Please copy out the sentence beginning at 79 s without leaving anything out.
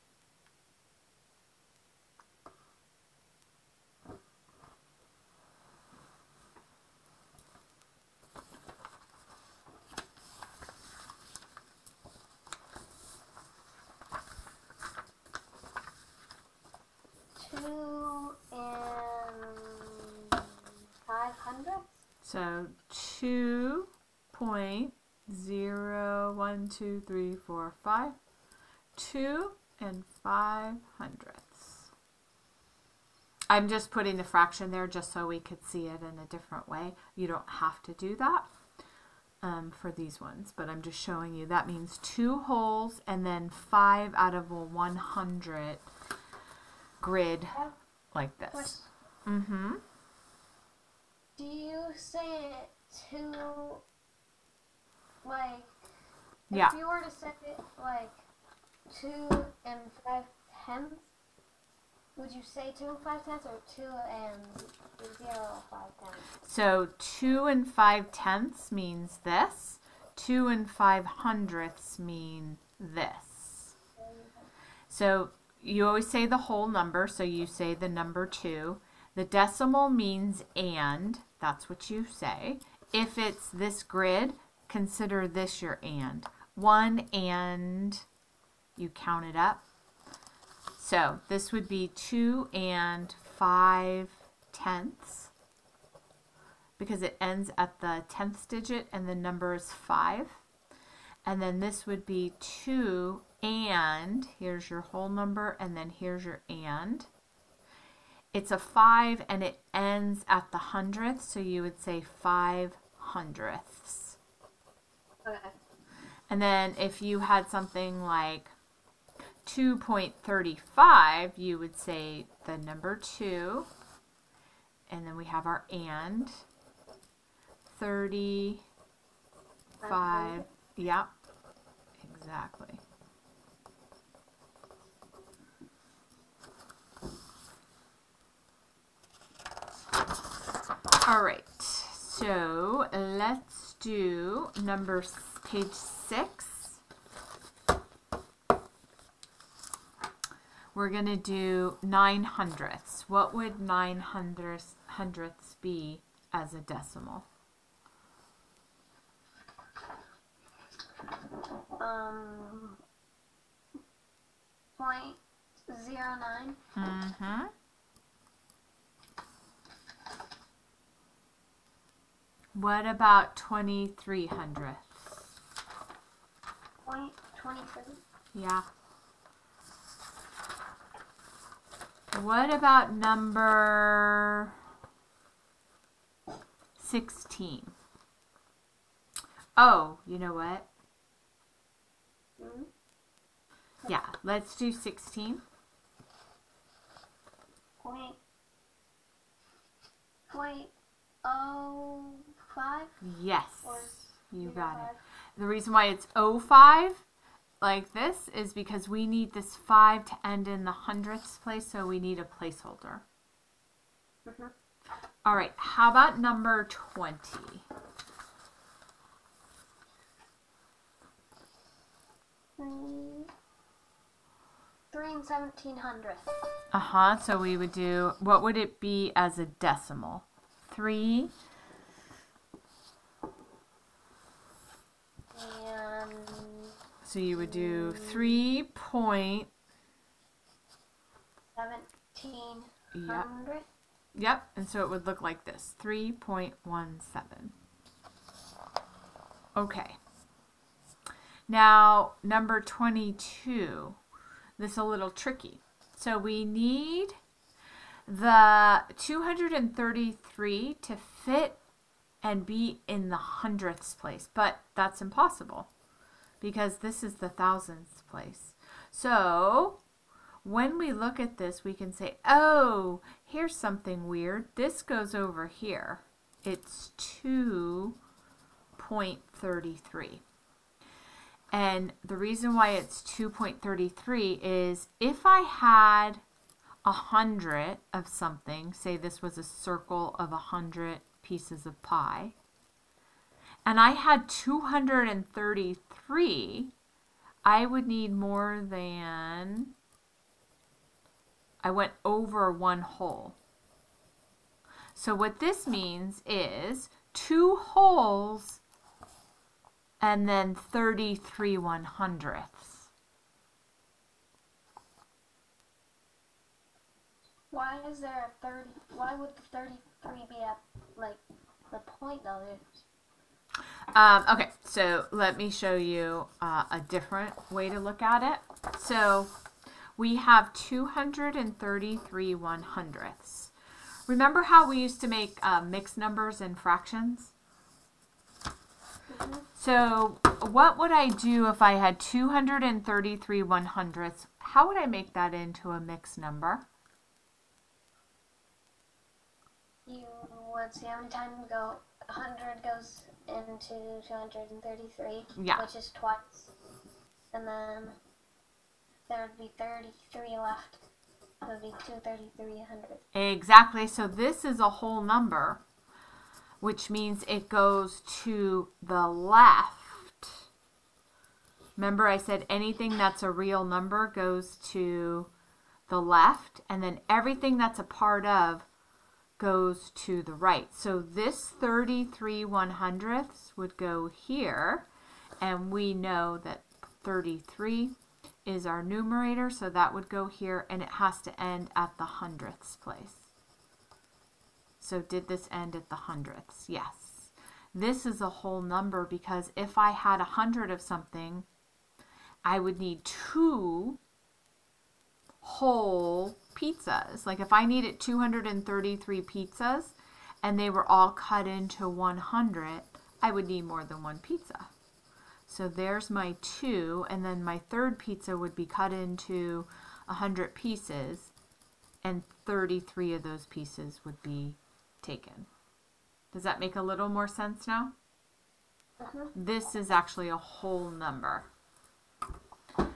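The decimal means and, that's what you say.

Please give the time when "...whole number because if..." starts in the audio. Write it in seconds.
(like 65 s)
398 s.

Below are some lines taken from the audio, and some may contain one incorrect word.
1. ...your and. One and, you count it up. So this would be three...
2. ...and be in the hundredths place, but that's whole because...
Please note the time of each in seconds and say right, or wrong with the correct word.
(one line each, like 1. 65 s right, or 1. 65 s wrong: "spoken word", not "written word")
1. 85 s wrong: "two", not "three"
2. 262 s wrong: "impossible", not "whole".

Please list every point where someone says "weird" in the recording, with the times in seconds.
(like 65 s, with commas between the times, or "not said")
274 s.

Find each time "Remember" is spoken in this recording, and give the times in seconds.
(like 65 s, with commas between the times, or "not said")
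334 s, 371 s.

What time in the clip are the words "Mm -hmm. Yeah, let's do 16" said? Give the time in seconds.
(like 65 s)
192 s.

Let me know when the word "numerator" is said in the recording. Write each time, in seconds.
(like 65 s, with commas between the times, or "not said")
388 s.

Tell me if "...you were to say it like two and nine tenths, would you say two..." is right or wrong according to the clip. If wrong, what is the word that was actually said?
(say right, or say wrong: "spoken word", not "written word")
wrong: "five", not "nine".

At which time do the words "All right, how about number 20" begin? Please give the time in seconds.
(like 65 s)
215 s.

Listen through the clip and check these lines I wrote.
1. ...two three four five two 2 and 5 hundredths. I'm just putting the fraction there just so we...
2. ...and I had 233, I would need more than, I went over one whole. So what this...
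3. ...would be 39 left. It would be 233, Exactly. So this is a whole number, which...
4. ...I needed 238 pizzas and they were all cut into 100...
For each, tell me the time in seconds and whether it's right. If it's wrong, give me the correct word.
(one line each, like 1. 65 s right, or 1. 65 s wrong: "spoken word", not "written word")
1. 26 s right
2. 293 s right
3. 359 s wrong: "33", not "39"
4. 407 s wrong: "233", not "238".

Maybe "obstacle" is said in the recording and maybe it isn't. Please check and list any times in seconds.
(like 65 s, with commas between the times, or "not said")
not said.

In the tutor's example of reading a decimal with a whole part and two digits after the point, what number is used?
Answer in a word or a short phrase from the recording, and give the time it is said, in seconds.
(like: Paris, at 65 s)
2.35, at 119 s.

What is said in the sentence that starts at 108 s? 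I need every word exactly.
It's a five and it ends at the hundredth, so you would say five hundredths.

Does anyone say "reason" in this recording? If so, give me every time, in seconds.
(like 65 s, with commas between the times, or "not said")
205 s, 282 s.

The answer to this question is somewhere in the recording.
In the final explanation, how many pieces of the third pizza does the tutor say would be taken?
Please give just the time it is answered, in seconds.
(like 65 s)
422 s.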